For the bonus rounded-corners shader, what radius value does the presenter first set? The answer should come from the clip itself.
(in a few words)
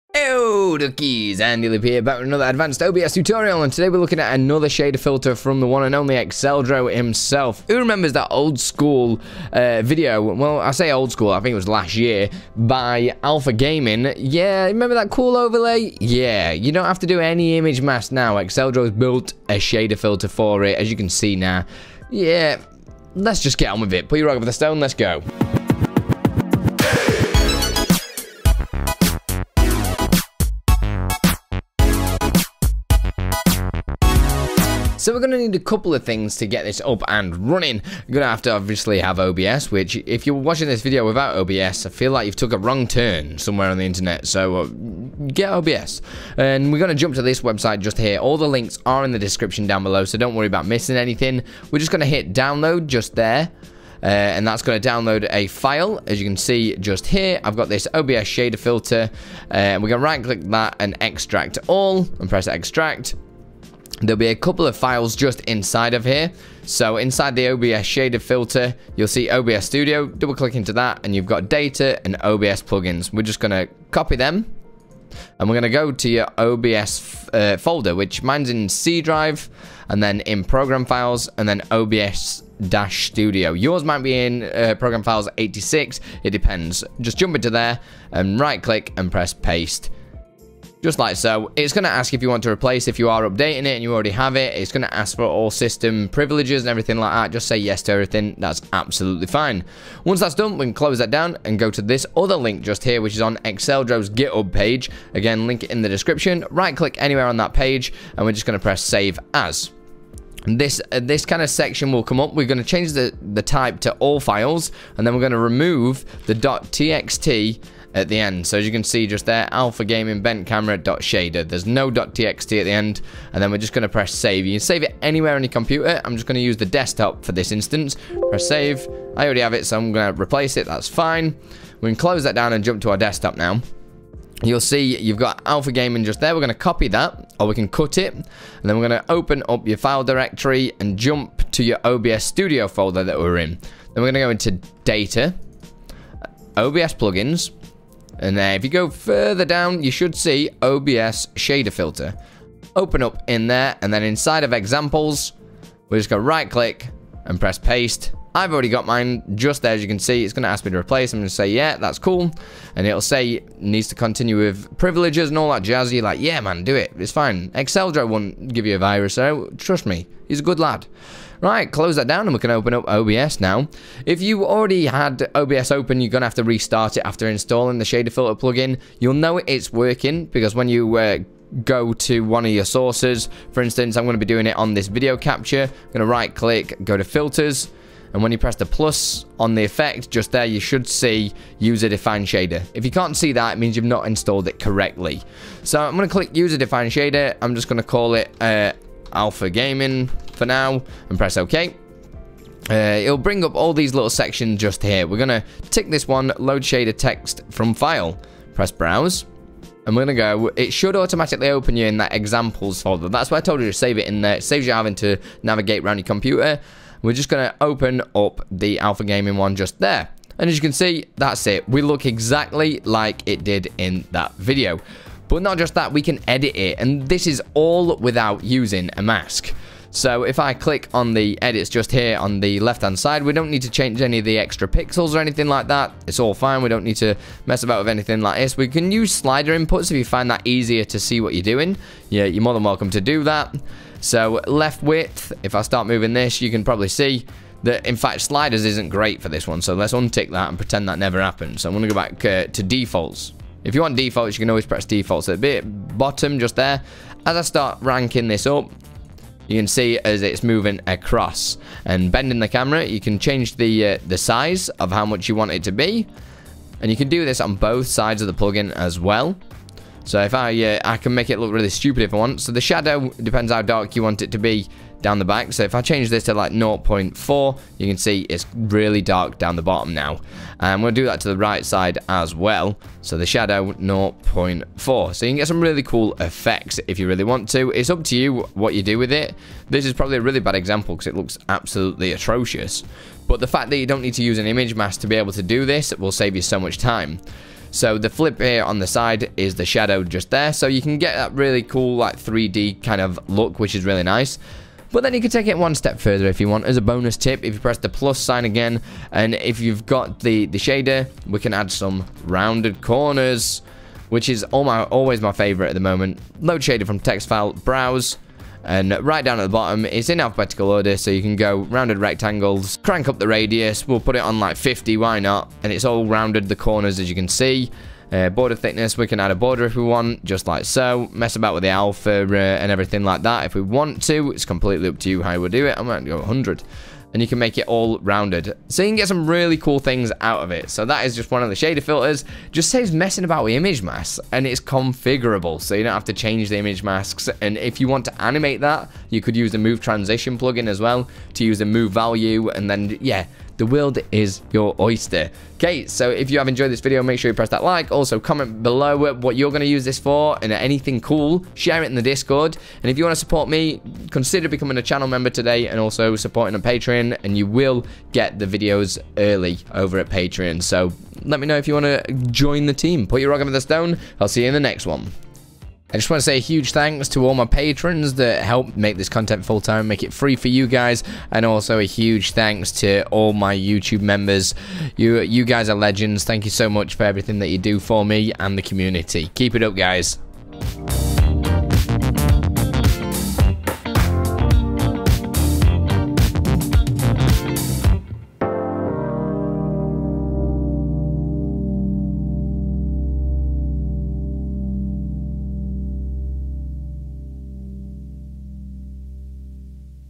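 50.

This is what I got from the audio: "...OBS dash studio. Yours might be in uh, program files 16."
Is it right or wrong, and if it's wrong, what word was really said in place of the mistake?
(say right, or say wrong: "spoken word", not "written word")
wrong: "86", not "16".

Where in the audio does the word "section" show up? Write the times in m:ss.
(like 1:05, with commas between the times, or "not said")
1:51, 3:24.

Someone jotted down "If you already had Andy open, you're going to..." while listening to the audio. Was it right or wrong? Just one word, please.
wrong.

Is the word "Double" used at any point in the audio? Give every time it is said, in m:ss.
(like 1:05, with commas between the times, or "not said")
1:10.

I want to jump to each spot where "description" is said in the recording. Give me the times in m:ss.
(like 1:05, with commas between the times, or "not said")
0:49, 1:45.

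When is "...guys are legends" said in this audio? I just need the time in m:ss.
6:25.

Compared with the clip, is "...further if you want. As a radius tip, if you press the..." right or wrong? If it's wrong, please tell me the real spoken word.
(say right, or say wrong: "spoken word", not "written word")
wrong: "bonus", not "radius".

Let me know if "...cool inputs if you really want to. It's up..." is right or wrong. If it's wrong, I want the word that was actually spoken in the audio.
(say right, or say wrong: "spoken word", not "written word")
wrong: "effects", not "inputs".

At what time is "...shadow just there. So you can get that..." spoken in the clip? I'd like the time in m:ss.
4:59.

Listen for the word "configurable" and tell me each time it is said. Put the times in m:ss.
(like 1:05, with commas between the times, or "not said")
5:44.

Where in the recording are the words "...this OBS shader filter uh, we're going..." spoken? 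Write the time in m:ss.
0:57.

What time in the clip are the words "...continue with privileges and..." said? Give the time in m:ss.
2:43.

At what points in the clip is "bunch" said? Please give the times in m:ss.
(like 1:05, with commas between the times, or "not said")
not said.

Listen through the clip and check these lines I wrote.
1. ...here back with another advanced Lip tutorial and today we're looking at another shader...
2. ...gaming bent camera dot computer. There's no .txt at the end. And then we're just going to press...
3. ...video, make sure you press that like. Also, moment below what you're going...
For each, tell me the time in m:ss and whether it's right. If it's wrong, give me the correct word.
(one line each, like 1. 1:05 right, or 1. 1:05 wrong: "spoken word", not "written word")
1. 0:01 wrong: "OBS", not "Lip"
2. 1:59 wrong: "shader", not "computer"
3. 5:56 wrong: "comment", not "moment".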